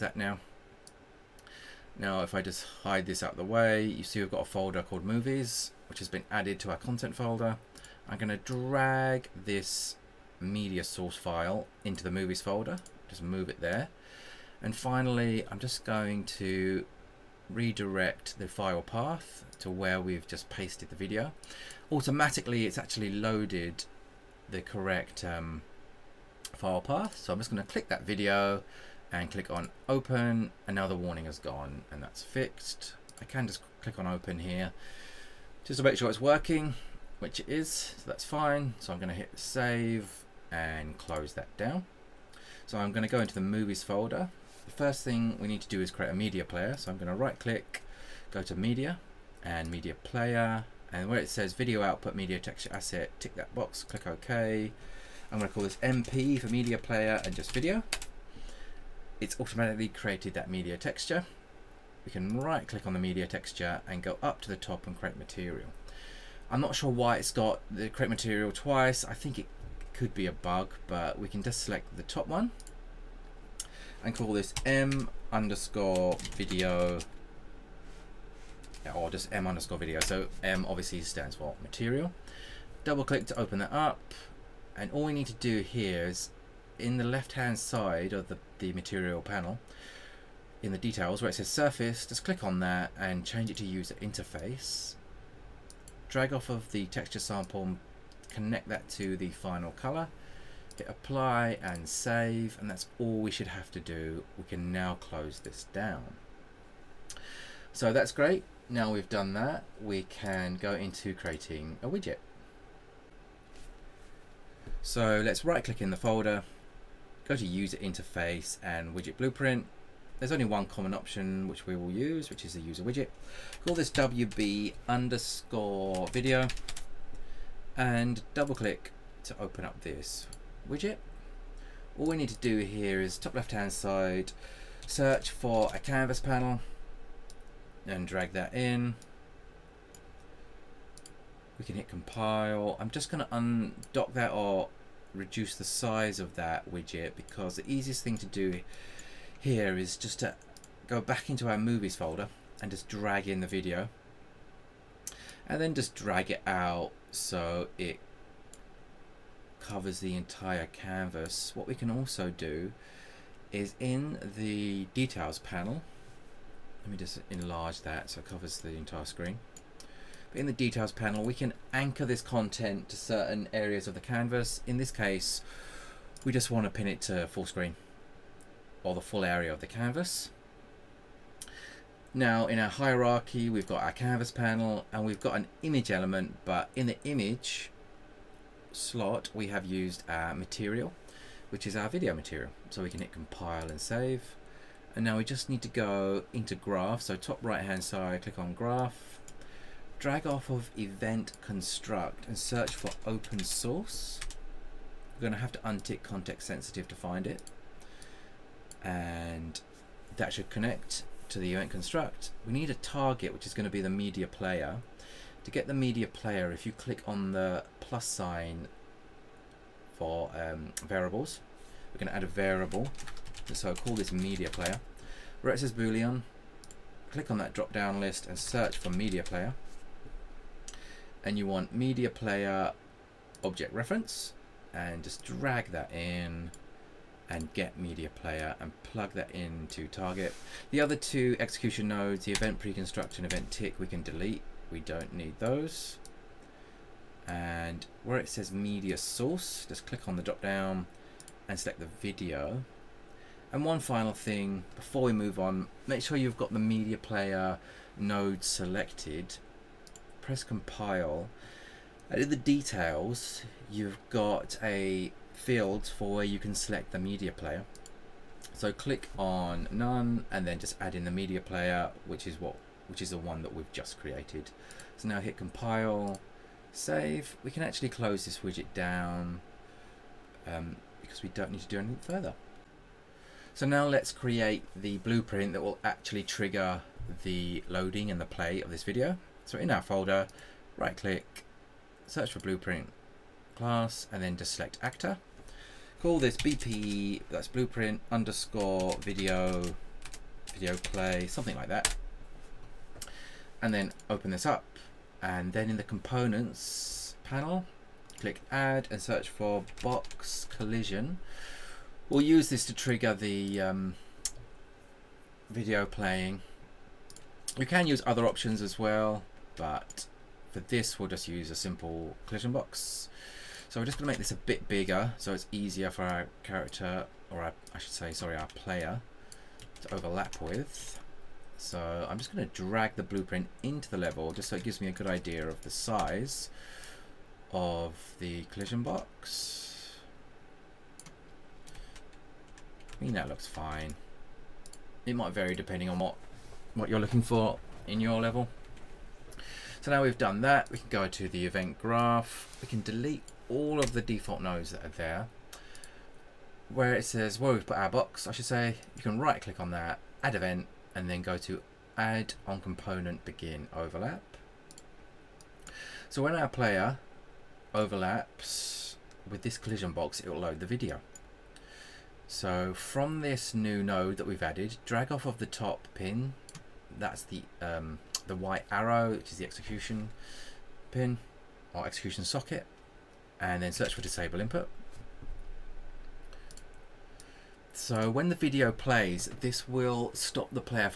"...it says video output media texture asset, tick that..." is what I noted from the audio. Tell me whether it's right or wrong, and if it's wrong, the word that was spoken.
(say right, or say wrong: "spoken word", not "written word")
right.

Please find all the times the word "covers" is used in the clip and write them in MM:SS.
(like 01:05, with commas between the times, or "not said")
02:39, 02:48.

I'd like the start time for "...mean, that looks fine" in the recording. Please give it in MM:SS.
05:43.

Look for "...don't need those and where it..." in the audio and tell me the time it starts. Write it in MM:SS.
04:04.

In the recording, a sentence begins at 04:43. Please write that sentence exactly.
So now let's create the blueprint that will actually trigger the loading and the play of this video.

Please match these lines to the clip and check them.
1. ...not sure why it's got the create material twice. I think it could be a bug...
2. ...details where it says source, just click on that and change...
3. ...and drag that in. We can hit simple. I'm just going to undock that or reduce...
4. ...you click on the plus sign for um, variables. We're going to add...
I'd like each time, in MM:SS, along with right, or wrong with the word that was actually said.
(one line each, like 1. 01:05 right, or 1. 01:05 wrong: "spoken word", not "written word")
1. 01:06 right
2. 01:30 wrong: "surface", not "source"
3. 02:17 wrong: "compile", not "simple"
4. 03:36 right.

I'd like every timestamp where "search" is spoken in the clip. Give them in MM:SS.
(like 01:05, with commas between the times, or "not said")
02:14, 03:22, 03:48, 04:52, 05:09, 06:23.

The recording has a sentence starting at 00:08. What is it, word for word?
I'm gonna drag this media source file into the movies folder, just move it there.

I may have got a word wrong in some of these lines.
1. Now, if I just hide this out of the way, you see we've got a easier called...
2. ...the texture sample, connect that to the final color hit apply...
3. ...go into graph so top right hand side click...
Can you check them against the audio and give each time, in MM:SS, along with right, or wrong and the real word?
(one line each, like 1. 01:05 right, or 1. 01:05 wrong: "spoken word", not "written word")
1. 00:01 wrong: "folder", not "easier"
2. 01:36 right
3. 03:15 right.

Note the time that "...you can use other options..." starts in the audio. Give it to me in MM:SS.
05:17.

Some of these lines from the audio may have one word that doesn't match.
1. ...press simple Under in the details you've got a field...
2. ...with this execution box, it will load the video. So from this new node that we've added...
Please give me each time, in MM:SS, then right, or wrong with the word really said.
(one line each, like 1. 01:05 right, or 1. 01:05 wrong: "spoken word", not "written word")
1. 04:20 wrong: "compile", not "simple"
2. 06:09 wrong: "collision", not "execution".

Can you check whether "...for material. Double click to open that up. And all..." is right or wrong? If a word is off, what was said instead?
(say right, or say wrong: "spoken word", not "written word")
right.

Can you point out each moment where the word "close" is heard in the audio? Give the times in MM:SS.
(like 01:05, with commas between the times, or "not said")
00:40, 01:44, 04:37.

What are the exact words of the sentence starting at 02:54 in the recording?
In this case, we just want to pin it to full screen or the full area of the canvas.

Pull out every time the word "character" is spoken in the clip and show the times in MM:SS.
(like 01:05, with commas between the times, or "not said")
05:26.